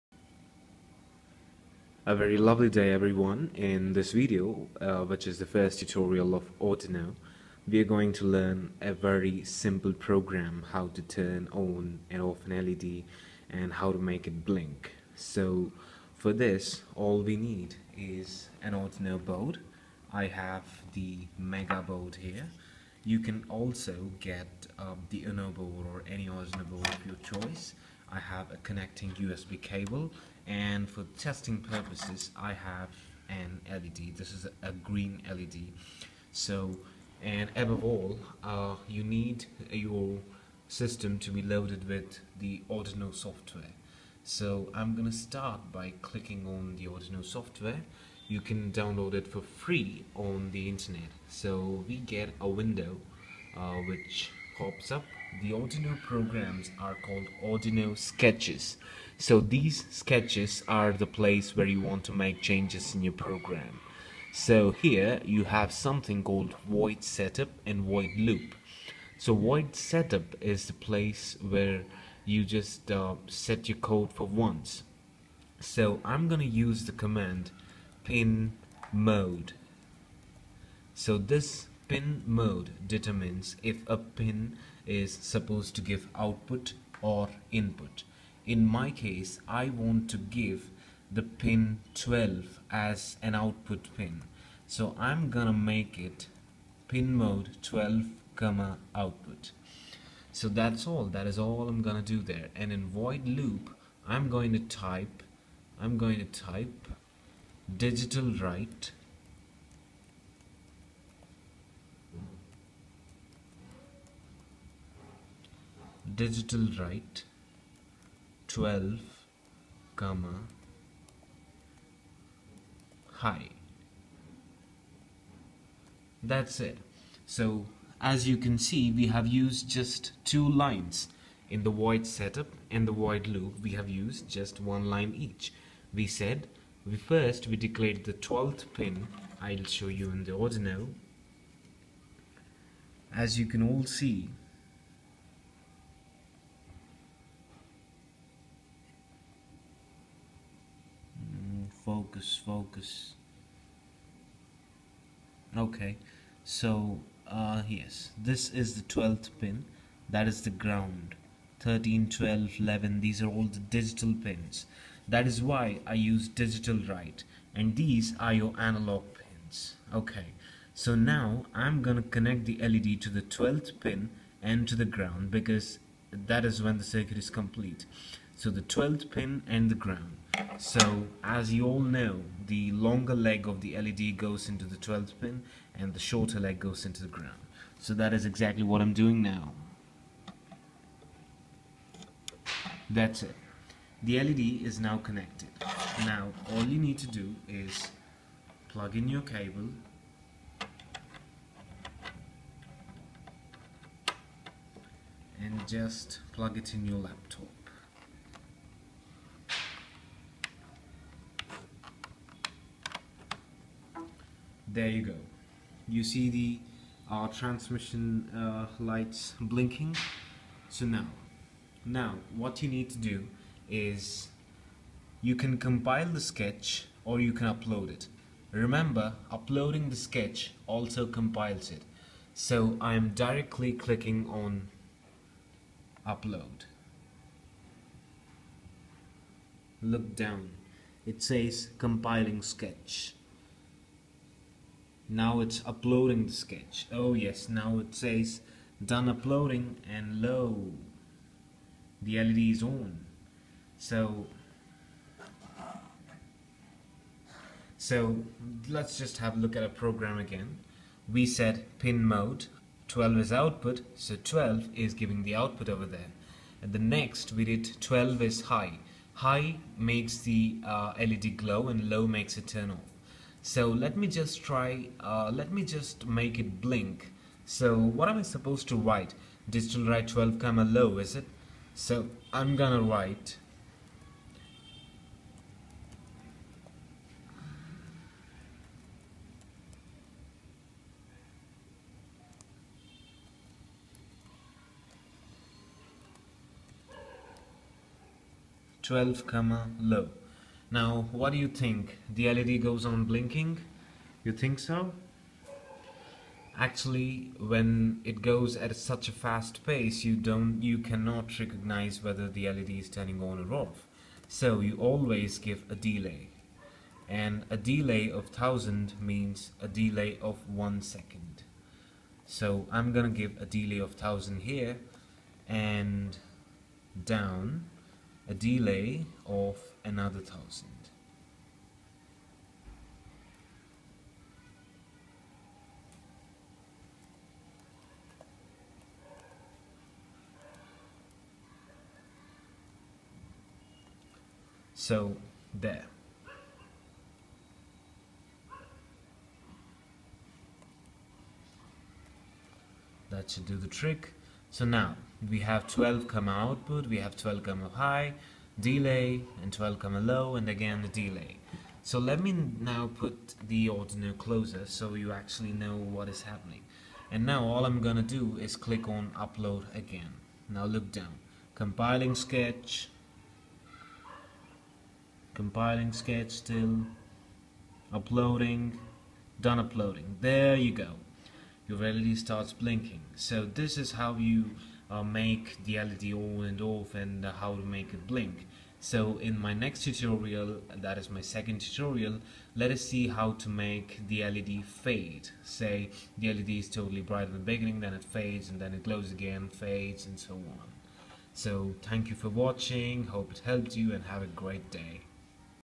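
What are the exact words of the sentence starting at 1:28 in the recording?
In my case, I want to give the pin 12 as an output pin.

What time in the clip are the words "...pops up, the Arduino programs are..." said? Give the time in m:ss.
0:54.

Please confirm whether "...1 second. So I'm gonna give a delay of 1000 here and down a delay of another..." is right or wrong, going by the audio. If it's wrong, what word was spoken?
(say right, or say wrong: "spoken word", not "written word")
right.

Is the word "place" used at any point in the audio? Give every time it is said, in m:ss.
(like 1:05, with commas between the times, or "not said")
1:01, 1:10.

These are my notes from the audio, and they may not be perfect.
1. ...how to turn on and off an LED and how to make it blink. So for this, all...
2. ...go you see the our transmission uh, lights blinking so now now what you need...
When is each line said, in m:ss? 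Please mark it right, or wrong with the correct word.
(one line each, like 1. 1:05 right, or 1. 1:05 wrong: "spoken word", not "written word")
1. 0:10 right
2. 3:35 right.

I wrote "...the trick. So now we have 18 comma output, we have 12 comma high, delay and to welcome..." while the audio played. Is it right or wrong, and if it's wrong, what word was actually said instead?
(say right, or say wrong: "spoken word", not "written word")
wrong: "12", not "18".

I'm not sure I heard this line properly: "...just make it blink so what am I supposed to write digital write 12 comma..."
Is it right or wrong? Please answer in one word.
right.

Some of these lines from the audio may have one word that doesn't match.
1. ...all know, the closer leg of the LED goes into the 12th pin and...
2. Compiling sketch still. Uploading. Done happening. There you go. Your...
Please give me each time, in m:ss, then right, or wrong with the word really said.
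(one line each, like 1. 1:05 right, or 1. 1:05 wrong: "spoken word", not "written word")
1. 3:01 wrong: "longer", not "closer"
2. 6:15 wrong: "uploading", not "happening".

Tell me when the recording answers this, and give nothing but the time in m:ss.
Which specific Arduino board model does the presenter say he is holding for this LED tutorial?
0:21.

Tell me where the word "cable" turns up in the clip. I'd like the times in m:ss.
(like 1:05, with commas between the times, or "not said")
0:29, 3:19.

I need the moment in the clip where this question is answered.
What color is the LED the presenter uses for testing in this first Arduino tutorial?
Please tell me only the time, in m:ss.
0:34.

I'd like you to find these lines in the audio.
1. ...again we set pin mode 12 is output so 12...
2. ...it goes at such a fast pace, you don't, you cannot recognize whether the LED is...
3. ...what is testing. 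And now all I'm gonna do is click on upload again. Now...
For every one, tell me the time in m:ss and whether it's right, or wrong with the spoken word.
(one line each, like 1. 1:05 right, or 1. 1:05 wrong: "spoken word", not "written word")
1. 4:20 right
2. 5:08 right
3. 6:05 wrong: "happening", not "testing".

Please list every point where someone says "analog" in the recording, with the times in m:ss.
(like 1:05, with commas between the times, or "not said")
2:48.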